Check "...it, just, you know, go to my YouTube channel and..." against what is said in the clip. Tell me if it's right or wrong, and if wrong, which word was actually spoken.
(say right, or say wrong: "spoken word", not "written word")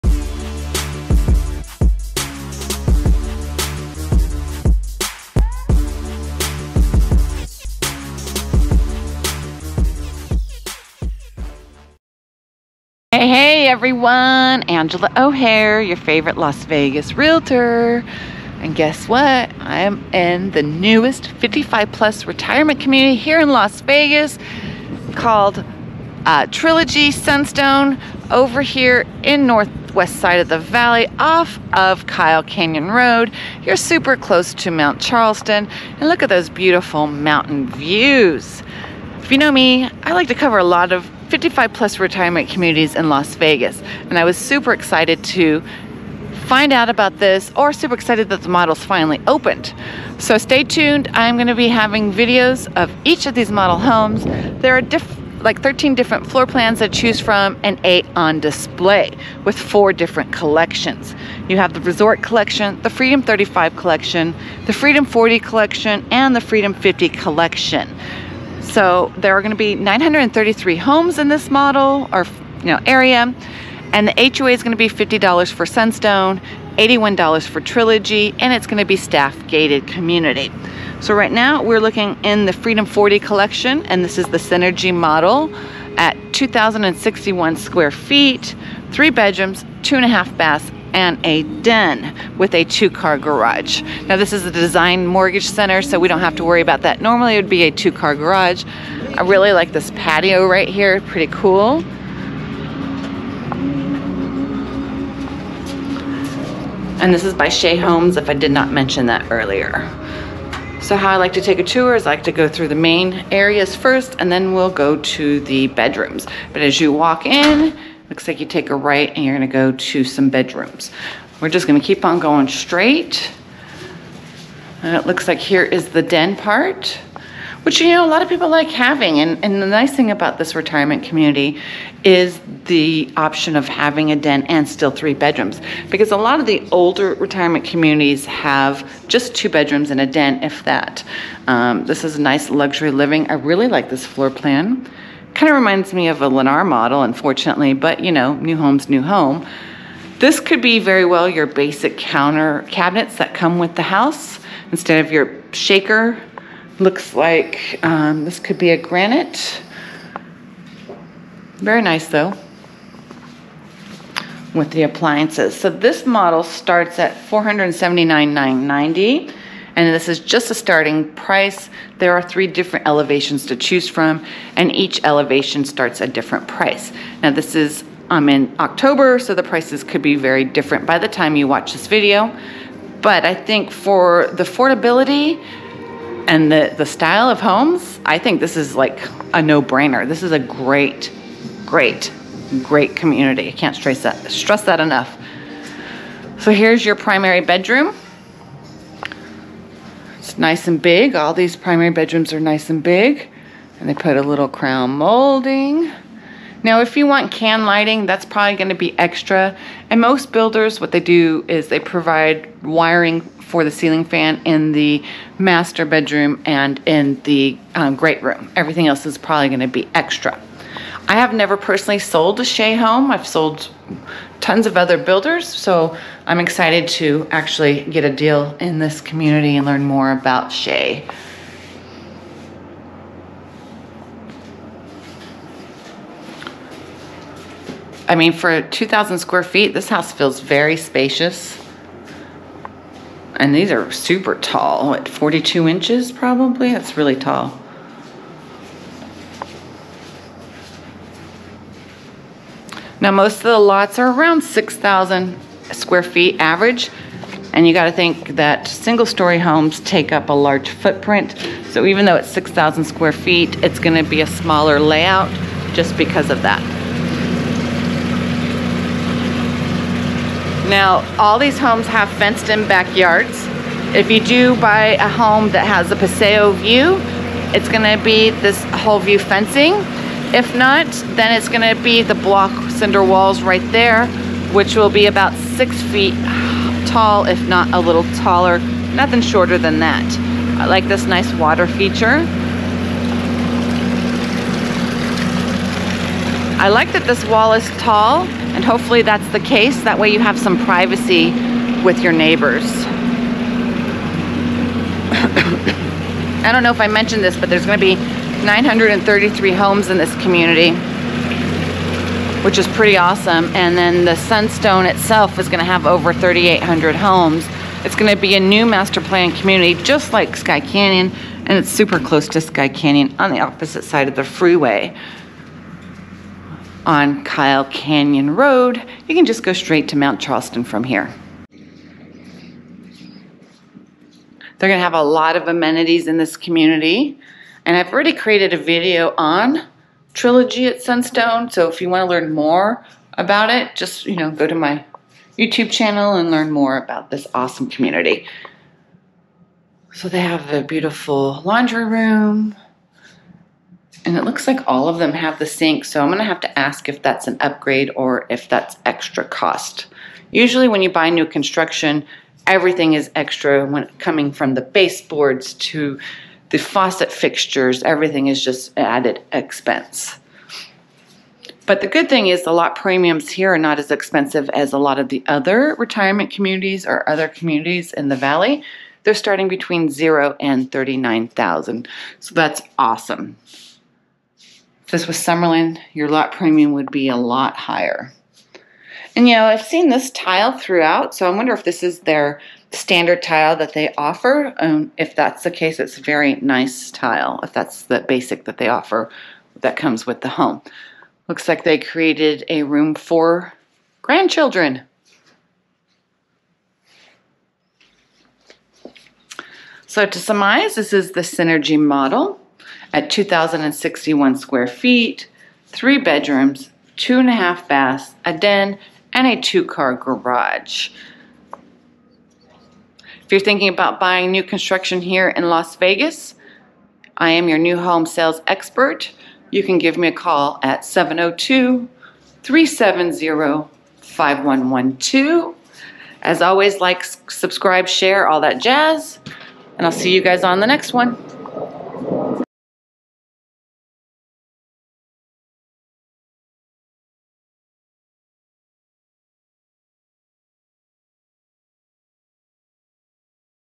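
right.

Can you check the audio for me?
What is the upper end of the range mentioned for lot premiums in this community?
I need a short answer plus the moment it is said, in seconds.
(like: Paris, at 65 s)
$39,000, at 380 s.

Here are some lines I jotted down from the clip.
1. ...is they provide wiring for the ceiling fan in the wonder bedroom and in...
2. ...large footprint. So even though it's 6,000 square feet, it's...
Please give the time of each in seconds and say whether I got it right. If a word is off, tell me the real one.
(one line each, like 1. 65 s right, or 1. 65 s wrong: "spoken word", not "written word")
1. 211 s wrong: "master", not "wonder"
2. 260 s right.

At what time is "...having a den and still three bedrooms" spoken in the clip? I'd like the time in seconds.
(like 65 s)
133 s.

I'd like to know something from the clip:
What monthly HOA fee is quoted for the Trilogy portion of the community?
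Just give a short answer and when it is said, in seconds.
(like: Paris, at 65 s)
$81, at 76 s.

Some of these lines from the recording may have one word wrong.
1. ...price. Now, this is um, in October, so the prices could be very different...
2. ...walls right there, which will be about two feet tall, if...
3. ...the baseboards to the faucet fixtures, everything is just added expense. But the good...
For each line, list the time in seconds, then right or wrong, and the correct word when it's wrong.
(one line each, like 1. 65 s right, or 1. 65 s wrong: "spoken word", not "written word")
1. 176 s right
2. 283 s wrong: "six", not "two"
3. 364 s right.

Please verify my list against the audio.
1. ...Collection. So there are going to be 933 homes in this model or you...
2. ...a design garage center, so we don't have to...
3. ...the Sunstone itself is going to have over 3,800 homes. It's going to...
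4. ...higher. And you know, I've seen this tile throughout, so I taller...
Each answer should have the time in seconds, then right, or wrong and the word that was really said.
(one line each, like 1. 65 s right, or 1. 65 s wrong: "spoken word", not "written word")
1. 67 s right
2. 94 s wrong: "mortgage", not "garage"
3. 314 s right
4. 387 s wrong: "wonder", not "taller".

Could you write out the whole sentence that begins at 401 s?
Looks like they created a room for grandchildren.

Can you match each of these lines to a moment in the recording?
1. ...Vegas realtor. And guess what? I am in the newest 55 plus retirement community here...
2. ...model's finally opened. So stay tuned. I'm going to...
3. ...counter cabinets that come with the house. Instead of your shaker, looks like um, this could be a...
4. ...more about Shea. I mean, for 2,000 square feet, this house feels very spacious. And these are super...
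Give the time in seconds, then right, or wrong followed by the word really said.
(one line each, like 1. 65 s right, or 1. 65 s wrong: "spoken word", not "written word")
1. 16 s right
2. 48 s right
3. 151 s right
4. 229 s right.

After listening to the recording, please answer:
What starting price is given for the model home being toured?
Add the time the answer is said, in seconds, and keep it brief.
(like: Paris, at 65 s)
$479,990, at 167 s.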